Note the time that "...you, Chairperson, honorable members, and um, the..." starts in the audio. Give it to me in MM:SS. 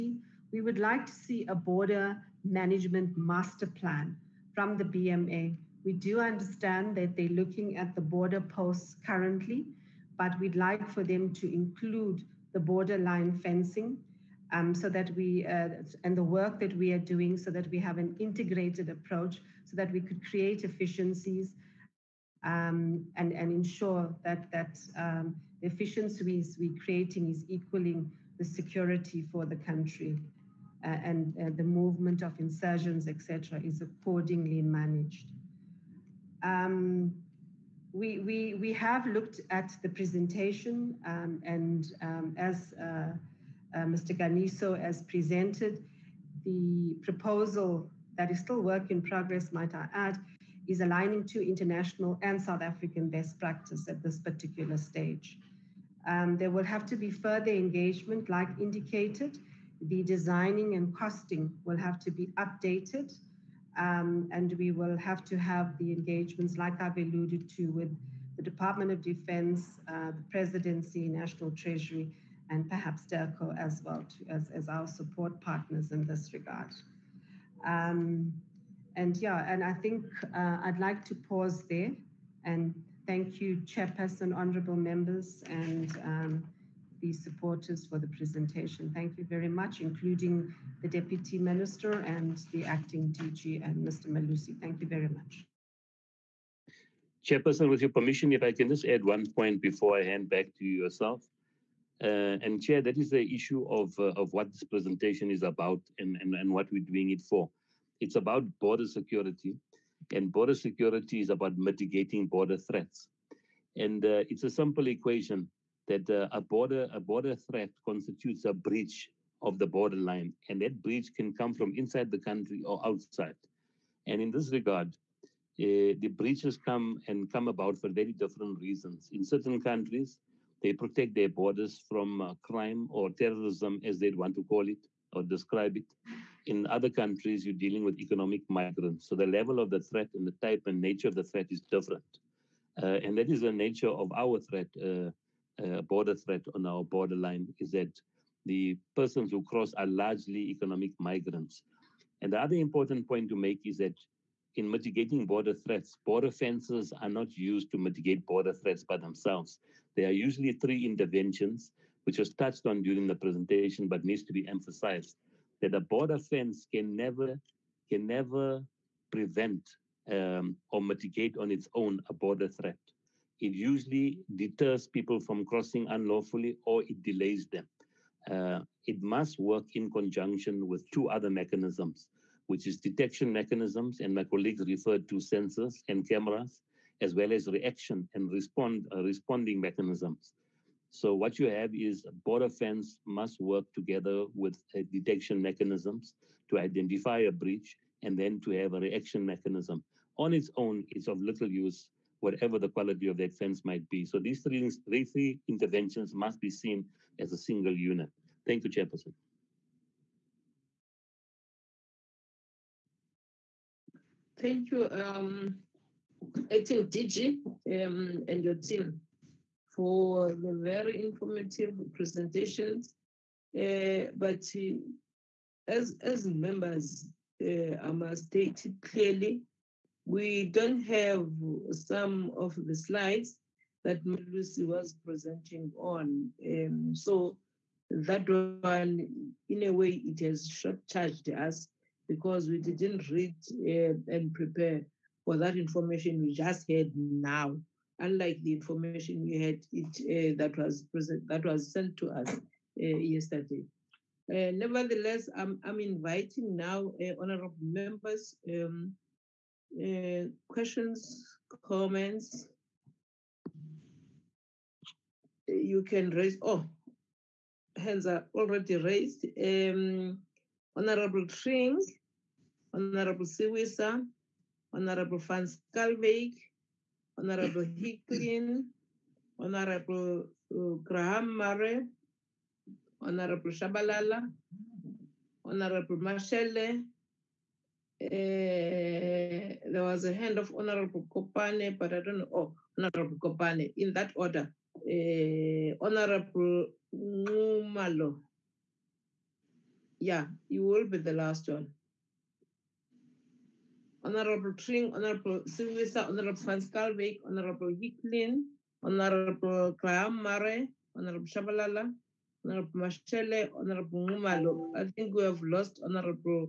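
01:23.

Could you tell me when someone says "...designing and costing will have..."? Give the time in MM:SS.
01:00.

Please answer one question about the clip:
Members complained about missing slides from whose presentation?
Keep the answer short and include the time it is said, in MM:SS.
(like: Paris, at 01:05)
Lucy, at 03:54.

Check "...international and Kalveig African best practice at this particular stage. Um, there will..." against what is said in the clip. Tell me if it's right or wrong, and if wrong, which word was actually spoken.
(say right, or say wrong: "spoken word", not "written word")
wrong: "South", not "Kalveig".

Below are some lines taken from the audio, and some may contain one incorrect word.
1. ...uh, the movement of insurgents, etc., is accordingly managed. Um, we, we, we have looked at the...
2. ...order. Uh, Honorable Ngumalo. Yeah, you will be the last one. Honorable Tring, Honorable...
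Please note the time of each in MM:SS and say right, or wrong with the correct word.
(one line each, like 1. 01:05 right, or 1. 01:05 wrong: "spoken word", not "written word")
1. 00:31 right
2. 04:54 right.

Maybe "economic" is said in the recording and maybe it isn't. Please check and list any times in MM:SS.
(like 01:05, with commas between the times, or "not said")
02:17, 02:30.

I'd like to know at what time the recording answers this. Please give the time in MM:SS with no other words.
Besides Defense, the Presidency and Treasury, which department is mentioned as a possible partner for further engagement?
01:13.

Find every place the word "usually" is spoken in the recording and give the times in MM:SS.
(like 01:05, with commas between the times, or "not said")
02:40, 02:53.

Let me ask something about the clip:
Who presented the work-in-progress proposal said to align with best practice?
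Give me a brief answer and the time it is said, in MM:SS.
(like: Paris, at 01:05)
Mr. Ganiso, at 00:43.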